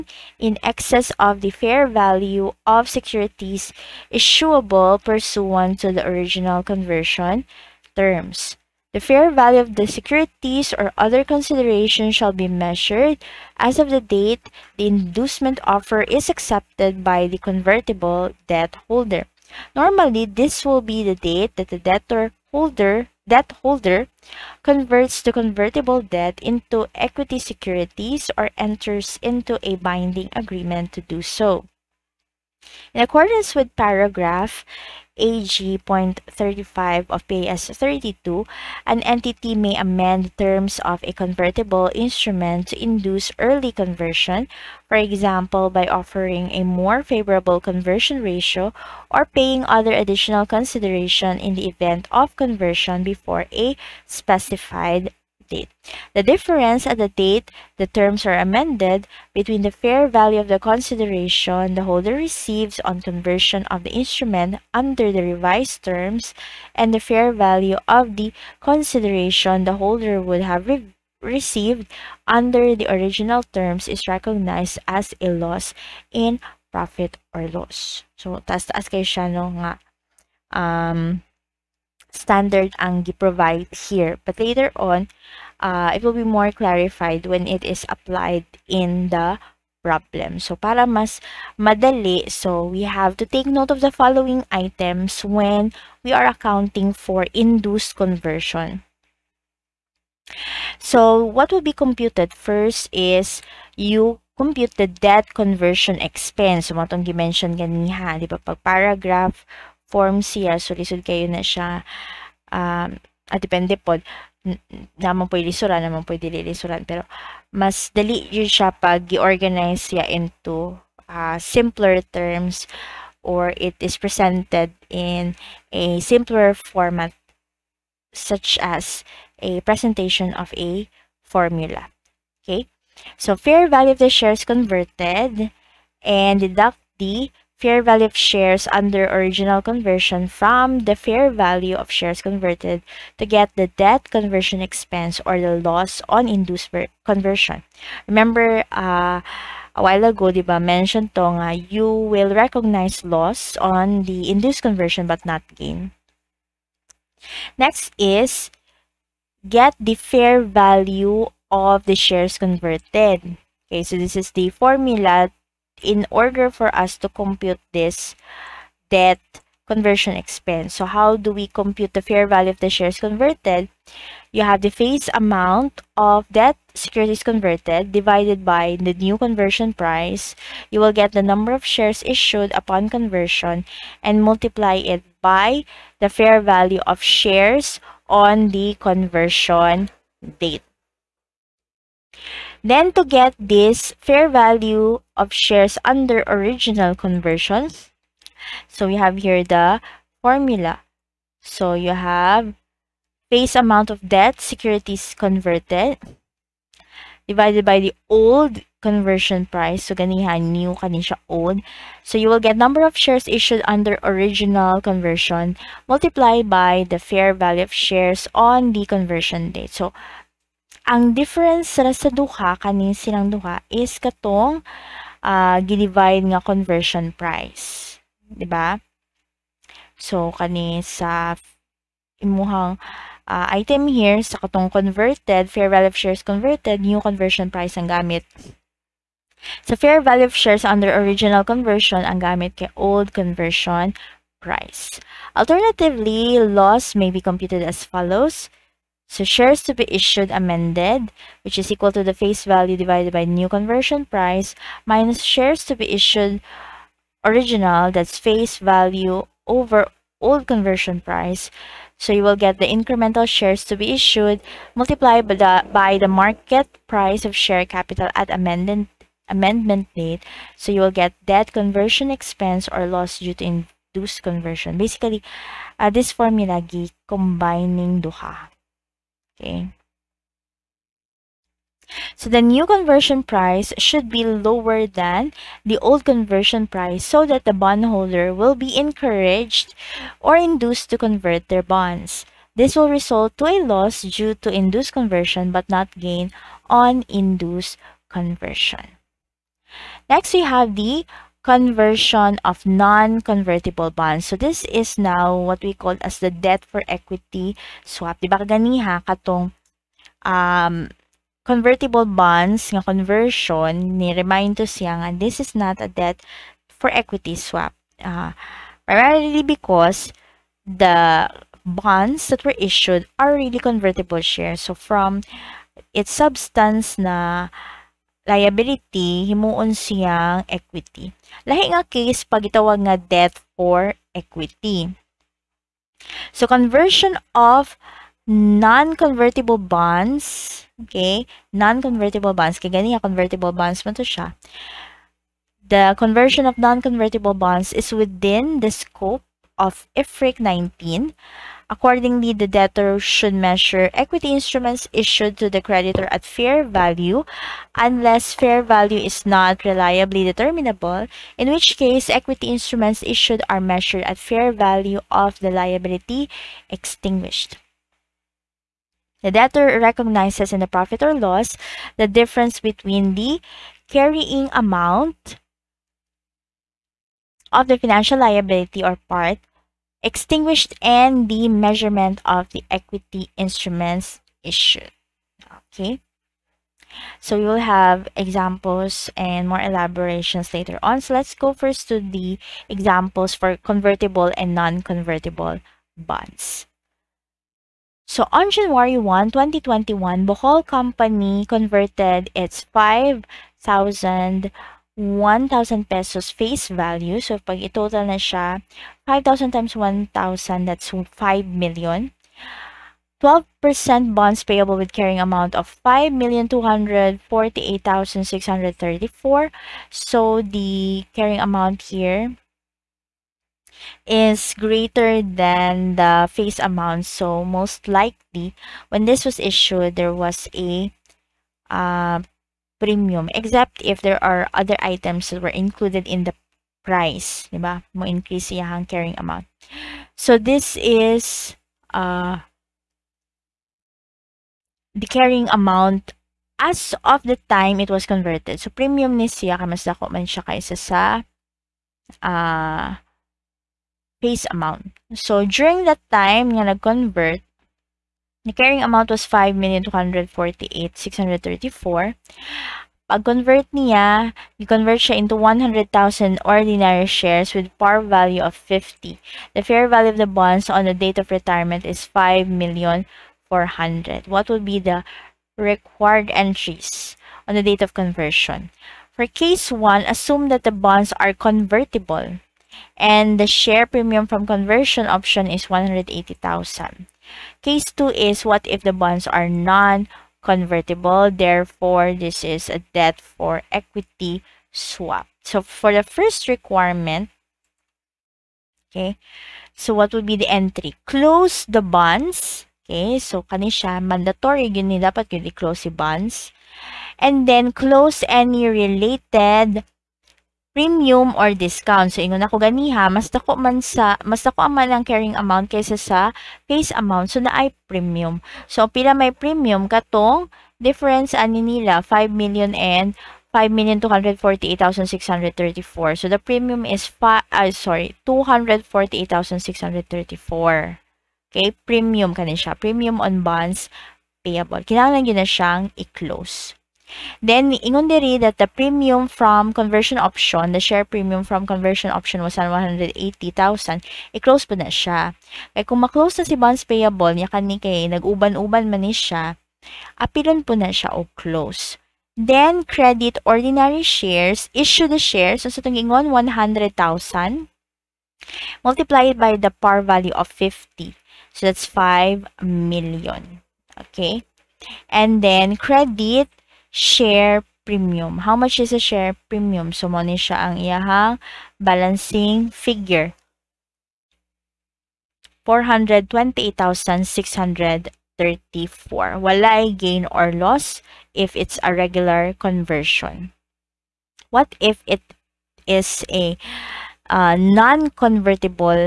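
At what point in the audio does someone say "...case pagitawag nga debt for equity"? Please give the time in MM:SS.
05:31.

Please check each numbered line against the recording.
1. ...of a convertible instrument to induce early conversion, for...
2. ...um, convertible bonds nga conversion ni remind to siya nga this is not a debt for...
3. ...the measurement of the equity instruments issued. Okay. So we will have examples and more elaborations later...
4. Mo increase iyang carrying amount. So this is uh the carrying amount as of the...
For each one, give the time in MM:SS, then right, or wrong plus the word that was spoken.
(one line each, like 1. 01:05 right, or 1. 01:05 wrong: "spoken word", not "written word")
1. 00:40 right
2. 05:10 right
3. 06:21 right
4. 07:17 right.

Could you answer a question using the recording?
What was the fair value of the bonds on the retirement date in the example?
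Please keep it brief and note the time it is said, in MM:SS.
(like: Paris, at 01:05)
5,400,000, at 07:52.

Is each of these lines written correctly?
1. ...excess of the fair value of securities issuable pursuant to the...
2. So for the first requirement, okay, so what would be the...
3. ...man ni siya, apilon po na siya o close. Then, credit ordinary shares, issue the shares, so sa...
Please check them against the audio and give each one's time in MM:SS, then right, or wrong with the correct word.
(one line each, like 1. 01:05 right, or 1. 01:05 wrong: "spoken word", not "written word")
1. 00:00 right
2. 08:15 right
3. 09:08 right.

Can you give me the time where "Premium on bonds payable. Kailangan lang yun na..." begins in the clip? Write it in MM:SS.
08:52.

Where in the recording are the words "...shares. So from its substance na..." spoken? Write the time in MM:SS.
05:24.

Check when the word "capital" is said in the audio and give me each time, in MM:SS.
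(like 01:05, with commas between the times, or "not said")
04:27.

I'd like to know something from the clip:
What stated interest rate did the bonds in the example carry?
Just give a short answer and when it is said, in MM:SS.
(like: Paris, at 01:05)
12%, at 06:53.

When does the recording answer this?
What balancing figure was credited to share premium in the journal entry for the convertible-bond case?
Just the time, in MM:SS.
09:35.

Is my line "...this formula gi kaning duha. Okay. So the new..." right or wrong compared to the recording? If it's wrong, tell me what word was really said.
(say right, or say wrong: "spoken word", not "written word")
wrong: "combining", not "kaning".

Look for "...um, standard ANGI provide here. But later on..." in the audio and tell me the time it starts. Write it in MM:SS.
01:20.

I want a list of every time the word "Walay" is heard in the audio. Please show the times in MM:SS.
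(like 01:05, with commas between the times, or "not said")
09:39.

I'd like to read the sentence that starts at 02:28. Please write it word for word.
Remember, uh, a while ago, diba mentioned tonga, nga, you will recognize loss on the induced conversion but not gain.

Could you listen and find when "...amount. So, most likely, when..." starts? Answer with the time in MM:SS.
07:06.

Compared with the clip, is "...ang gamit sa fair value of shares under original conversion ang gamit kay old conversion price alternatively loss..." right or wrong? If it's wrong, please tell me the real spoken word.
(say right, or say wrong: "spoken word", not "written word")
right.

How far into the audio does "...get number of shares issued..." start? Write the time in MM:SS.
03:32.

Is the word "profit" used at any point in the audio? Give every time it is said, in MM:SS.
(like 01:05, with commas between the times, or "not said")
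01:16, 06:10.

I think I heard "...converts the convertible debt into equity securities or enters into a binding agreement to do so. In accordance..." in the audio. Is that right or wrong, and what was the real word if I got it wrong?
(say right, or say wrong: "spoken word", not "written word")
right.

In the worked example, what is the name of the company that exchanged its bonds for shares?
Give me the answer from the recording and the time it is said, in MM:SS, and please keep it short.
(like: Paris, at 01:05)
Bohol Company, at 06:40.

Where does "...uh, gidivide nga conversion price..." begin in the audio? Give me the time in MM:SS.
03:45.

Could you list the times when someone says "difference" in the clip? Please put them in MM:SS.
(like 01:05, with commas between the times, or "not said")
00:56, 03:41, 06:12, 08:40.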